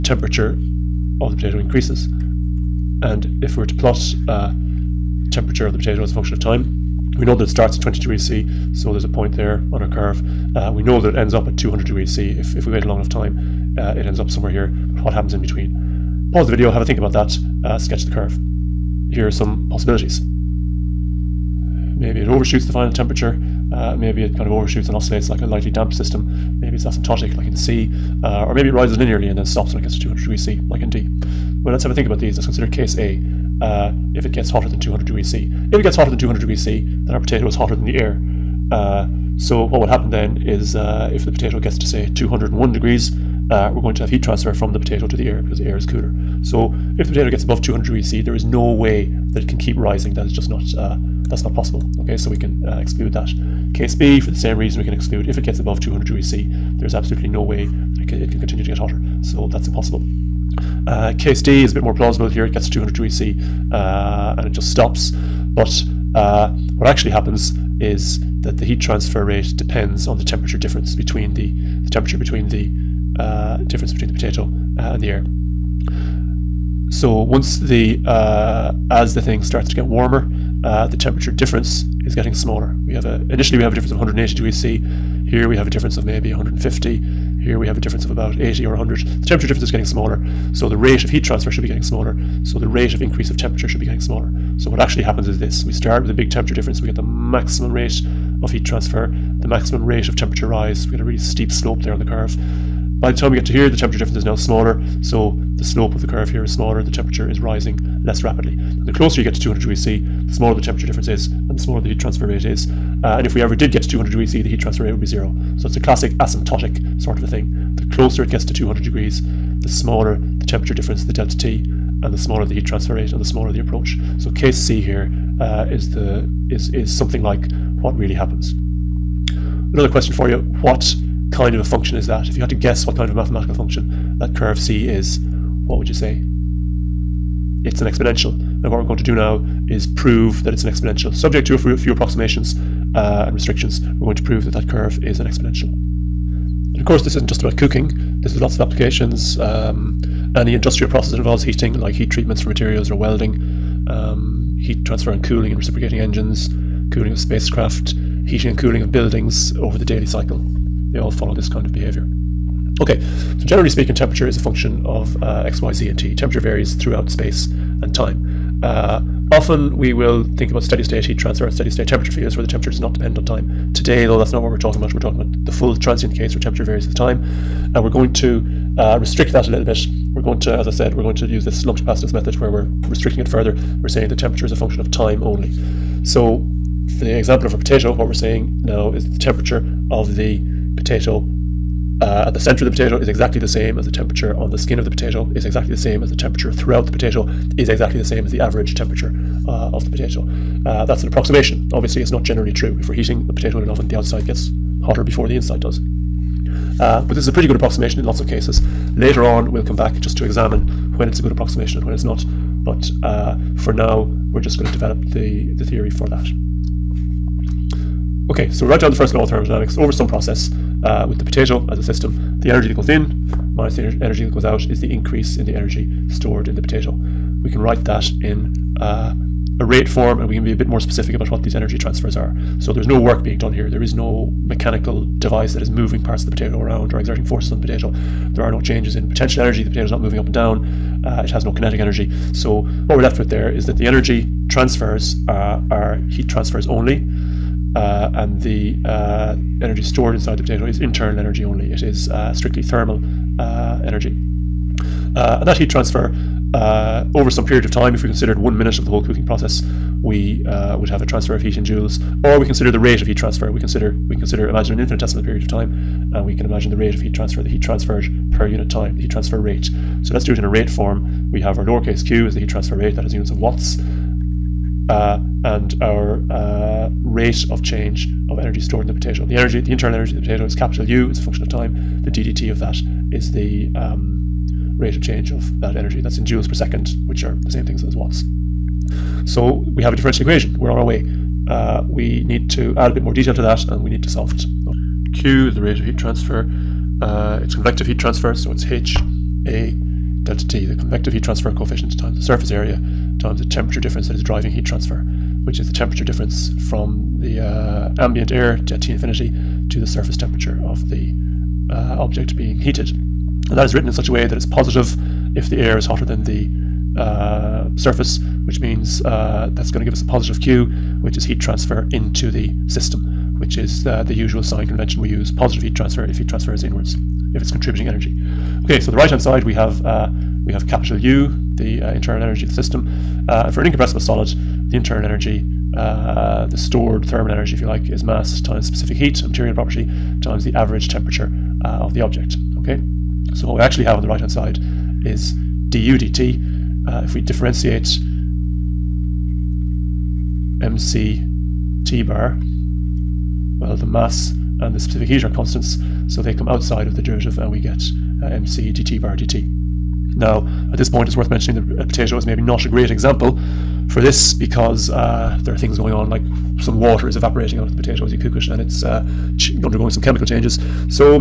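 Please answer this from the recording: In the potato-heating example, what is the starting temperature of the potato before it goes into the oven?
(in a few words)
20 degrees C.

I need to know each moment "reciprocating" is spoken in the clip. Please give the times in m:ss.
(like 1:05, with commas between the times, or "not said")
2:35.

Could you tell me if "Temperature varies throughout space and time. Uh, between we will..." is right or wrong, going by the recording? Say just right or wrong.
wrong.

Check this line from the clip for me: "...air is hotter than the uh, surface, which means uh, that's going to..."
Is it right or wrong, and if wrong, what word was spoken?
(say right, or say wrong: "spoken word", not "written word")
right.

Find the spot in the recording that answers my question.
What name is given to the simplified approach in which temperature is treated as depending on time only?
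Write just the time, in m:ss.
3:01.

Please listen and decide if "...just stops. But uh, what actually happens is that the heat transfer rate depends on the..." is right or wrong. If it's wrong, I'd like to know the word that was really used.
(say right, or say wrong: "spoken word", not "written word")
right.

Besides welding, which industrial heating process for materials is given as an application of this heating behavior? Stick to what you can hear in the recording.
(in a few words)
Heat treatments.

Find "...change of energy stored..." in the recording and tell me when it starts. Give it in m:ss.
4:37.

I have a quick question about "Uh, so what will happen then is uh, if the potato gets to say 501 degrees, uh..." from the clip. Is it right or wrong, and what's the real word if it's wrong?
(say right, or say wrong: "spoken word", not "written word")
wrong: "201", not "501".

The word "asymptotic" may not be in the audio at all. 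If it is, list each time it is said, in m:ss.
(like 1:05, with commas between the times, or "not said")
0:26, 1:56.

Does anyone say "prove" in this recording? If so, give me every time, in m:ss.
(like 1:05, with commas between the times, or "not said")
2:19, 2:24.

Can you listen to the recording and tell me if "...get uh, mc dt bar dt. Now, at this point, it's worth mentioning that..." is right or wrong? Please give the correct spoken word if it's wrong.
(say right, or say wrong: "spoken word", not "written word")
right.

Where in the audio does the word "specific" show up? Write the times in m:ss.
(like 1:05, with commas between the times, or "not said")
3:50, 5:38, 5:54.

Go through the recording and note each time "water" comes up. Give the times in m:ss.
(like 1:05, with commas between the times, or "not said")
6:06.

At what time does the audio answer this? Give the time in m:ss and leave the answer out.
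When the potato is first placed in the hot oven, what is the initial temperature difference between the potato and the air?
1:23.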